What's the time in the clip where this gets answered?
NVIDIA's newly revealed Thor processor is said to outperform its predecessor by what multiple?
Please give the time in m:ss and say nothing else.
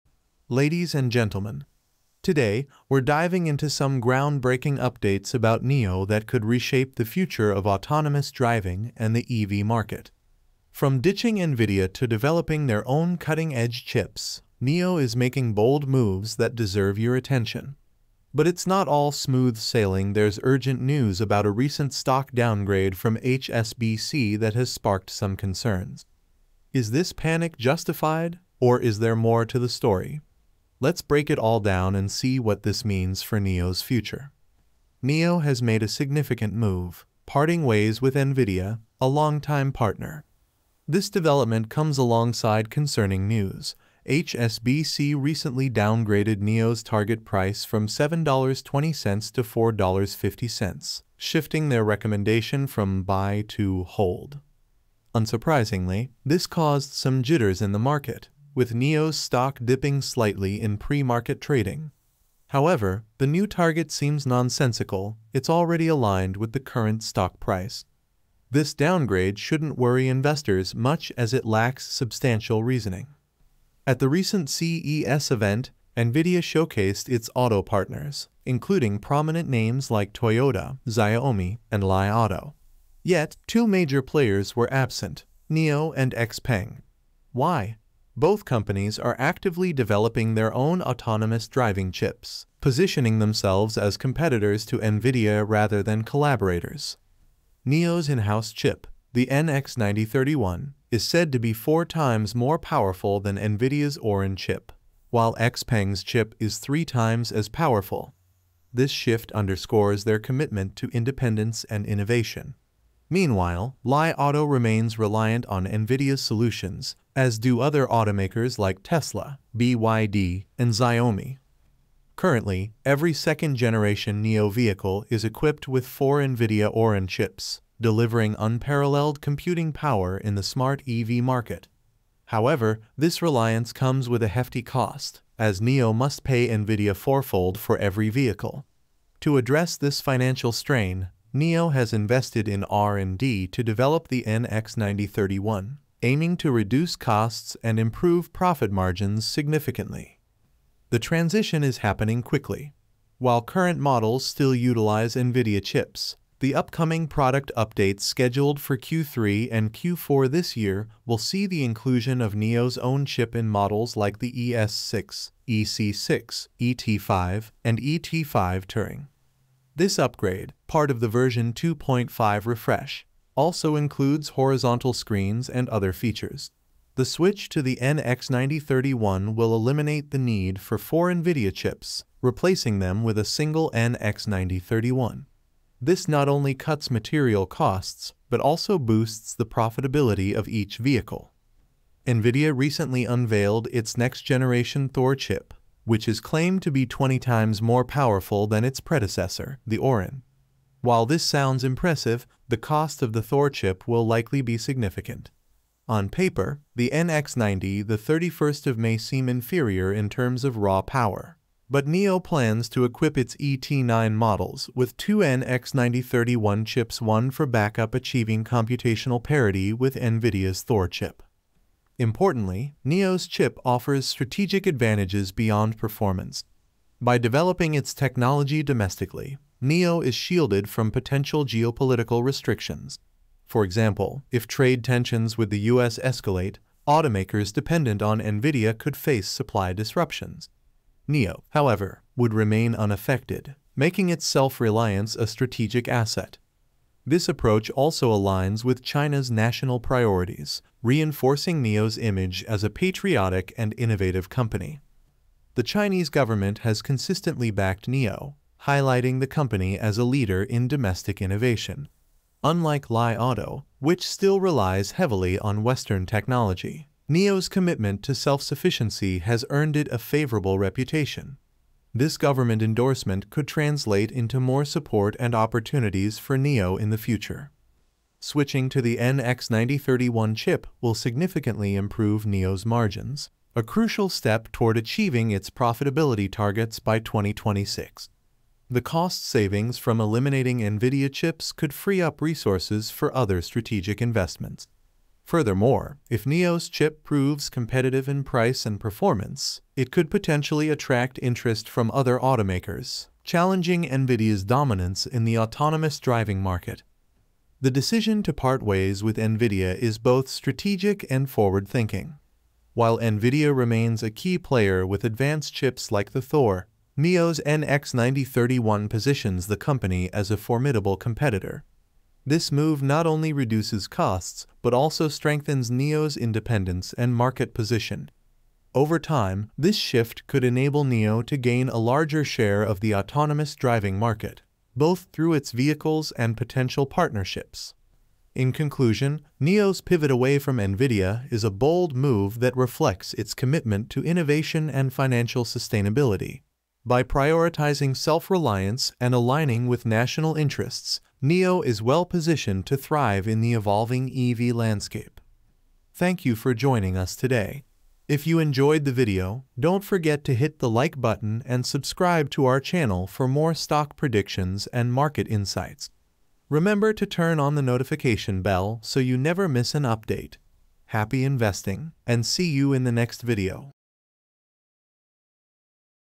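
3:16.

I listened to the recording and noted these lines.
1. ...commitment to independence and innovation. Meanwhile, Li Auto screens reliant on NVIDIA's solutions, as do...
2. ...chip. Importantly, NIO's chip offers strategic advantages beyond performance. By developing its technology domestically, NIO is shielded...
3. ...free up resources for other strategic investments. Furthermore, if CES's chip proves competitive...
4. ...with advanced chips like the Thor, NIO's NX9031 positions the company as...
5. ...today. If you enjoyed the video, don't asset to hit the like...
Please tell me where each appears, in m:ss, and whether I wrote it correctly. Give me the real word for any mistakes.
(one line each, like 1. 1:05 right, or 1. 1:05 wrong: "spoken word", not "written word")
1. 1:50 wrong: "remains", not "screens"
2. 3:40 right
3. 4:51 wrong: "NIO", not "CES"
4. 5:14 right
5. 5:57 wrong: "forget", not "asset".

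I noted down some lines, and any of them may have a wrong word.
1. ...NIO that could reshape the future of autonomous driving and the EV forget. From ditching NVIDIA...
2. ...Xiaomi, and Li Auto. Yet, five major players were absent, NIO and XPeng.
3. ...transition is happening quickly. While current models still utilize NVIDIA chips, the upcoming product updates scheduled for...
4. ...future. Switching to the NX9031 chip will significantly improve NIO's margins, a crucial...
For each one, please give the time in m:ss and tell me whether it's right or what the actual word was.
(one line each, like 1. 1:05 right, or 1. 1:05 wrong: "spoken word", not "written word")
1. 0:05 wrong: "market", not "forget"
2. 1:20 wrong: "two", not "five"
3. 2:30 right
4. 4:36 right.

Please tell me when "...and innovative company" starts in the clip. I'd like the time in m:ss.
4:13.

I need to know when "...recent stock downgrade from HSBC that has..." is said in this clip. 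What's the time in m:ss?
0:21.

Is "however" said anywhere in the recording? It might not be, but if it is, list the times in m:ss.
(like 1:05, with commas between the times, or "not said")
1:02, 2:12, 4:01.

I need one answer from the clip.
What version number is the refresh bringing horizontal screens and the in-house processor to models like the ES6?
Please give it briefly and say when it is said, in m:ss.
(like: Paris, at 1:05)
2.5, at 2:51.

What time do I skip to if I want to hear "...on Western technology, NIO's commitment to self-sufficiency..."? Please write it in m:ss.
4:25.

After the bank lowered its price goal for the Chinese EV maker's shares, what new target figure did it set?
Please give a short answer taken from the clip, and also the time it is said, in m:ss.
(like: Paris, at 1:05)
$4.50, at 0:49.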